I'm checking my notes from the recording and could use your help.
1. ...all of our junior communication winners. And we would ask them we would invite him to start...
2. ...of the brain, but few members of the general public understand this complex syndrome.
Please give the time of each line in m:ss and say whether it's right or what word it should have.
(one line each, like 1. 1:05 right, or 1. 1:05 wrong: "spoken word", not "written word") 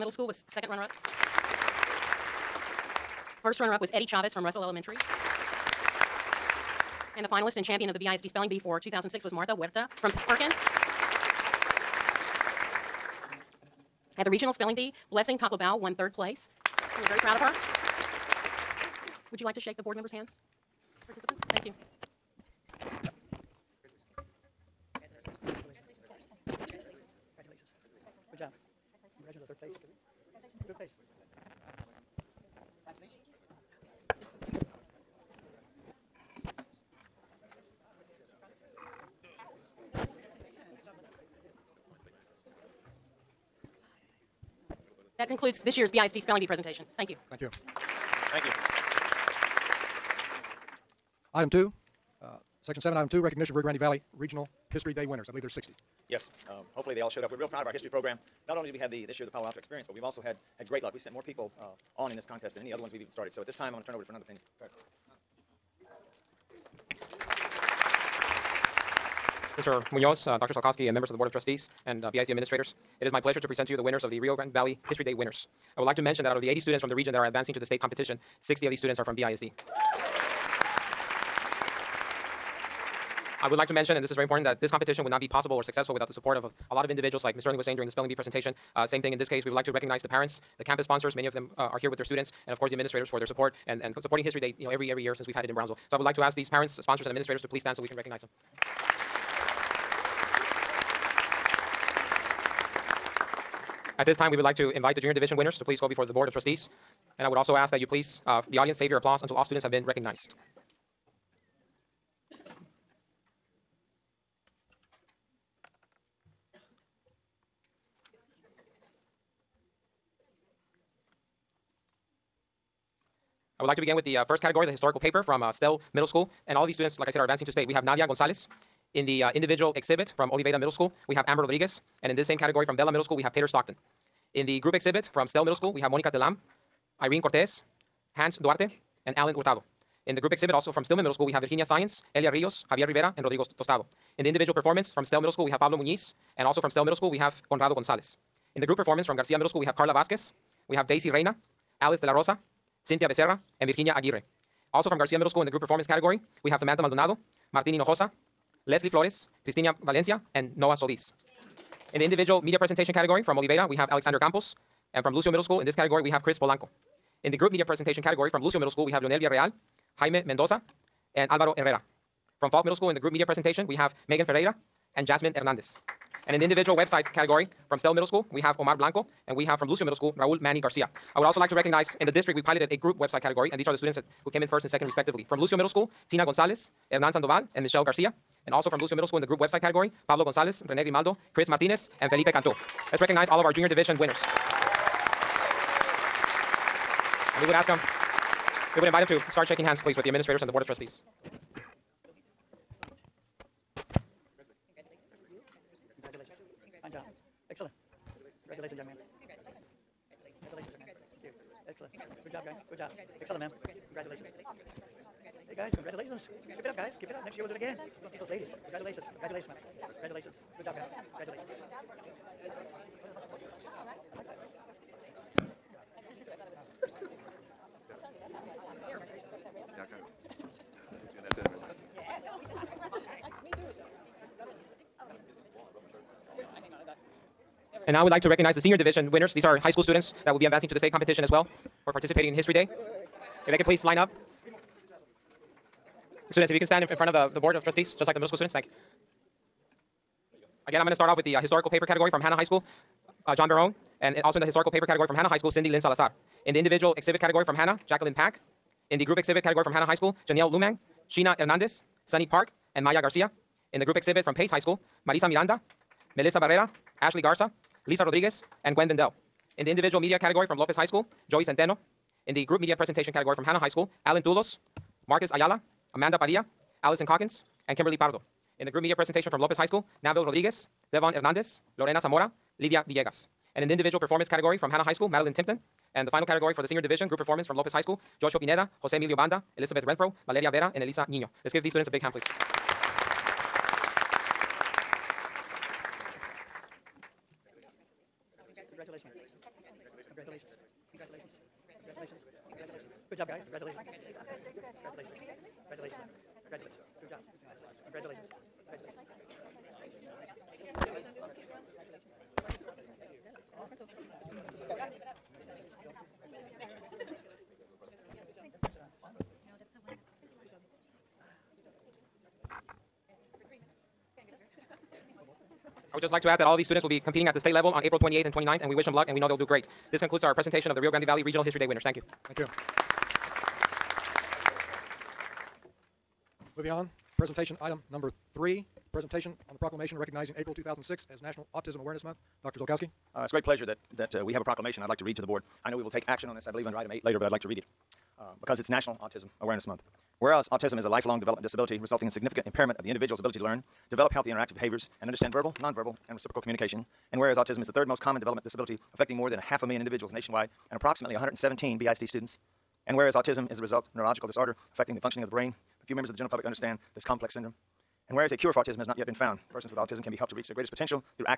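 1. 3:13 wrong: "division", not "communication"
2. 6:05 right.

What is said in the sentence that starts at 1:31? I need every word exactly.
Many of them uh, are here with their students, and of course the administrators for their support and and supporting History Day.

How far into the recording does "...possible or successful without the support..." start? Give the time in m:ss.
1:25.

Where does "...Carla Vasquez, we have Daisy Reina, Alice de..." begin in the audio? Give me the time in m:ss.
2:29.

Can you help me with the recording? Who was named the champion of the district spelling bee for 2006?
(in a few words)
Martha Huerta.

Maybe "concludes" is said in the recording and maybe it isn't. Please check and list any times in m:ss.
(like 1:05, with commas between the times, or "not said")
0:45, 5:30.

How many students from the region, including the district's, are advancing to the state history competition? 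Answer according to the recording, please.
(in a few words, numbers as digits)
80.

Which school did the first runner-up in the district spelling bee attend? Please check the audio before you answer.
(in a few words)
Russell Elementary.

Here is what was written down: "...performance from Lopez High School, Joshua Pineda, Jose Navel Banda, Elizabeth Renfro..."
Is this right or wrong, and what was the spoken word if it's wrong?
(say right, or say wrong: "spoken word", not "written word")
wrong: "Emilio", not "Navel".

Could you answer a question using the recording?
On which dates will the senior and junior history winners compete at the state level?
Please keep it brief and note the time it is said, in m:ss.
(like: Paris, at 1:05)
April 28th and 29th, at 5:27.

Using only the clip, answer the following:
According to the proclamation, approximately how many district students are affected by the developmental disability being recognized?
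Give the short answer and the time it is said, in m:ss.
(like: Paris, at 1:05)
117, at 6:01.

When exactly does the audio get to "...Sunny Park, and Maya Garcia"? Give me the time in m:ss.
4:22.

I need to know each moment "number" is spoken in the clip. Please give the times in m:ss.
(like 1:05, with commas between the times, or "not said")
5:37.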